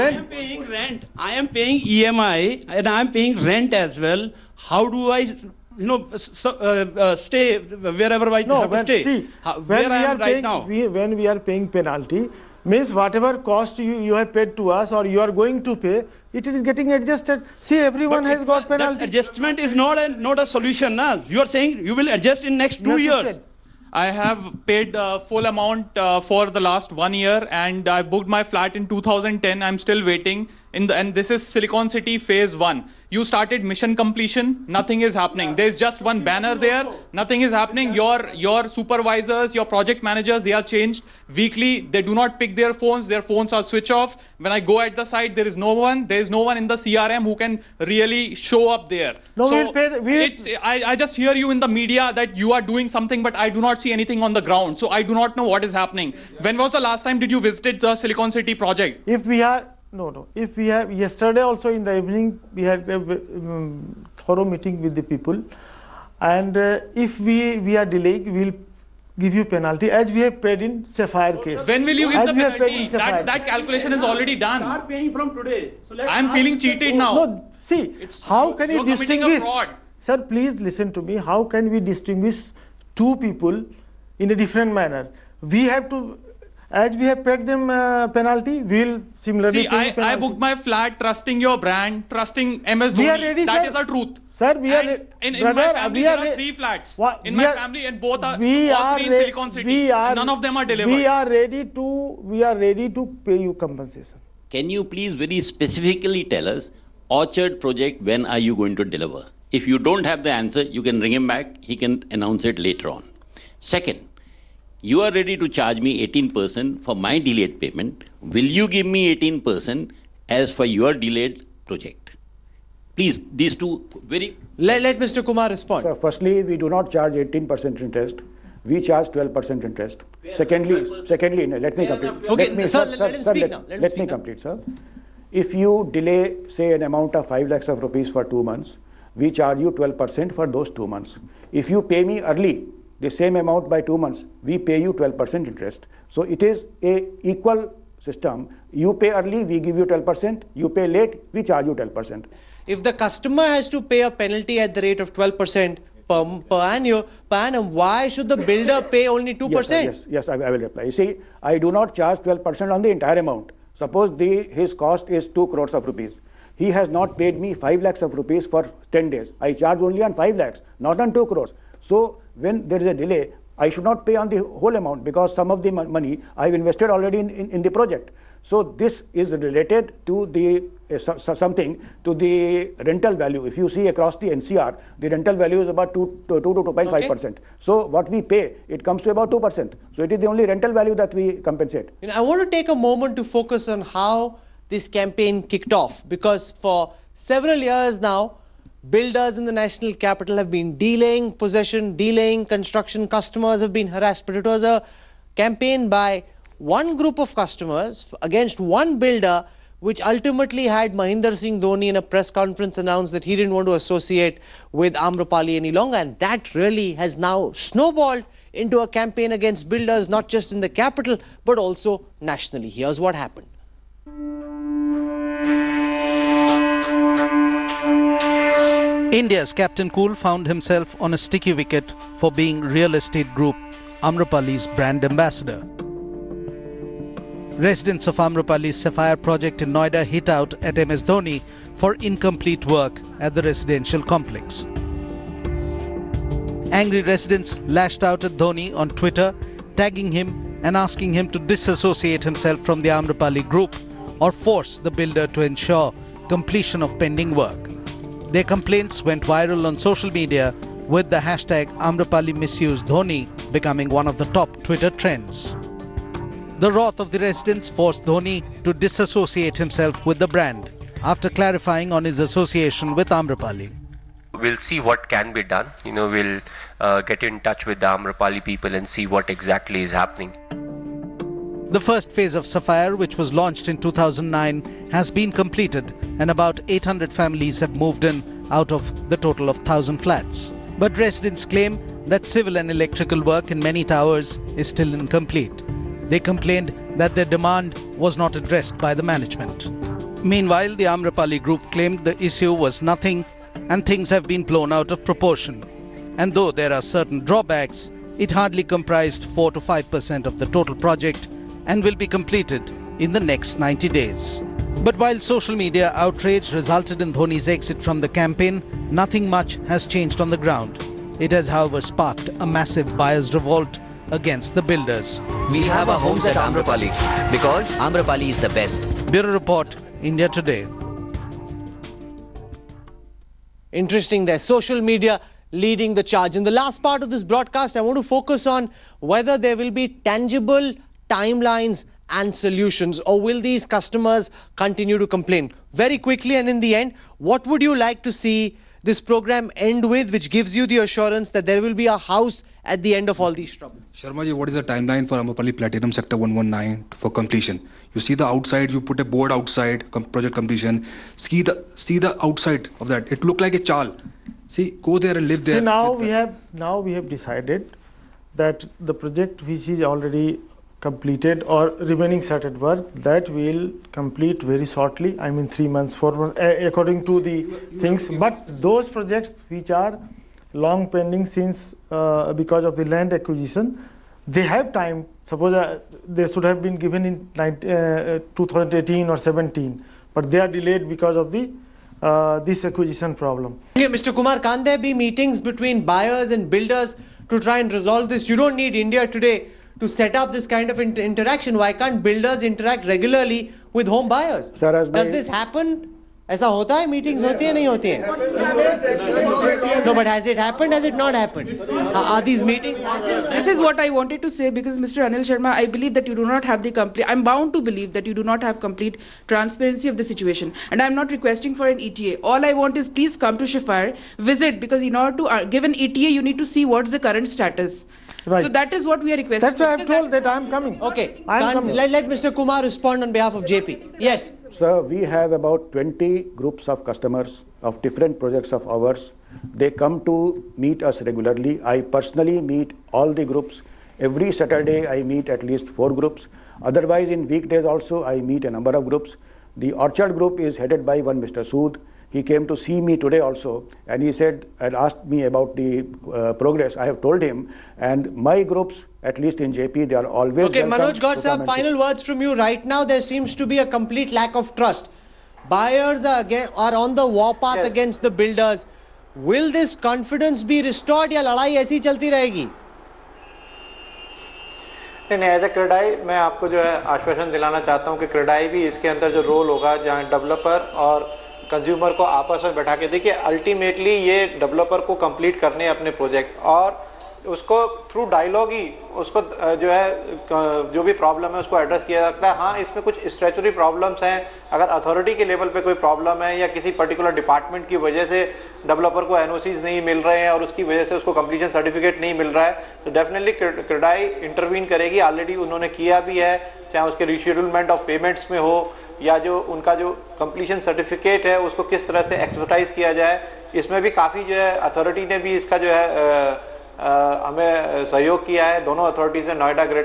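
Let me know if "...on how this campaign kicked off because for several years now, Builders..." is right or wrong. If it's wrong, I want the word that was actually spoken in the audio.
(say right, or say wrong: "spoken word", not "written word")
right.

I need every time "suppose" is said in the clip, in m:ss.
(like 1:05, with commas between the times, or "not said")
2:43, 6:25.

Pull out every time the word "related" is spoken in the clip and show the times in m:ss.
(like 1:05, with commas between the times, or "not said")
2:59.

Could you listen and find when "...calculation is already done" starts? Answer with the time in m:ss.
1:13.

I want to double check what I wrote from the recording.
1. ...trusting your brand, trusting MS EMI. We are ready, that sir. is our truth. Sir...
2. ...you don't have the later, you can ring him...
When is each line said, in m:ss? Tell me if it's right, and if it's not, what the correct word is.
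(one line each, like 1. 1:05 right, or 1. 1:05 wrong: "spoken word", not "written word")
1. 1:30 wrong: "Dhoni", not "EMI"
2. 1:49 wrong: "answer", not "later".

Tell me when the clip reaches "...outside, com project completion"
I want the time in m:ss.
5:59.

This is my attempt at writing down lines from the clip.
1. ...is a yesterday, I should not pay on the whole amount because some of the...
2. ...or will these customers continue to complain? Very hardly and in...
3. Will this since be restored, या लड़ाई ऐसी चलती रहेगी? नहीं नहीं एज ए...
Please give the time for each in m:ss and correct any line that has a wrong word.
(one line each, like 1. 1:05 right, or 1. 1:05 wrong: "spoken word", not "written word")
1. 2:52 wrong: "delay", not "yesterday"
2. 5:43 wrong: "quickly", not "hardly"
3. 7:49 wrong: "confidence", not "since".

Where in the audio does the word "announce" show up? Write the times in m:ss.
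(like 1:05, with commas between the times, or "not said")
1:52, 3:32.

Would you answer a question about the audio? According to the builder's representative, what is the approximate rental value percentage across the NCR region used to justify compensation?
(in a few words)
2 to 2.5 percent.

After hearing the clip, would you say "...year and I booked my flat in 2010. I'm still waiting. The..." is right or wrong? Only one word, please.
right.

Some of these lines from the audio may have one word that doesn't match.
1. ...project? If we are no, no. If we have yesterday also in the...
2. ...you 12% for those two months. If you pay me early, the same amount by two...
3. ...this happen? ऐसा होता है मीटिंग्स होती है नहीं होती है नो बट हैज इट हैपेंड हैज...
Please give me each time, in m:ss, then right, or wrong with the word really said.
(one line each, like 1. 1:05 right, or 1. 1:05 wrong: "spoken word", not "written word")
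1. 0:58 right
2. 2:19 right
3. 6:45 right.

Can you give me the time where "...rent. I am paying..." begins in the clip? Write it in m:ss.
0:00.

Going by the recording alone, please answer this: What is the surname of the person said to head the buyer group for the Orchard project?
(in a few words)
Sood.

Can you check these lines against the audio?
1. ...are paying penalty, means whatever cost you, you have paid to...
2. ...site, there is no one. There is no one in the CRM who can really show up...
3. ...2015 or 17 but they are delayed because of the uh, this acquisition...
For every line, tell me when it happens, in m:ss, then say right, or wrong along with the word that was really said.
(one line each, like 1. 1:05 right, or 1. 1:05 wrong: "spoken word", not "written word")
1. 0:11 right
2. 0:45 right
3. 6:28 wrong: "2018", not "2015".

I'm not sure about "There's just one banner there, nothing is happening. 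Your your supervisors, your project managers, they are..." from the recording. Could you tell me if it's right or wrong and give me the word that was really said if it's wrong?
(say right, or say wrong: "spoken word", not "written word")
right.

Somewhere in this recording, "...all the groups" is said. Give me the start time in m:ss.
7:22.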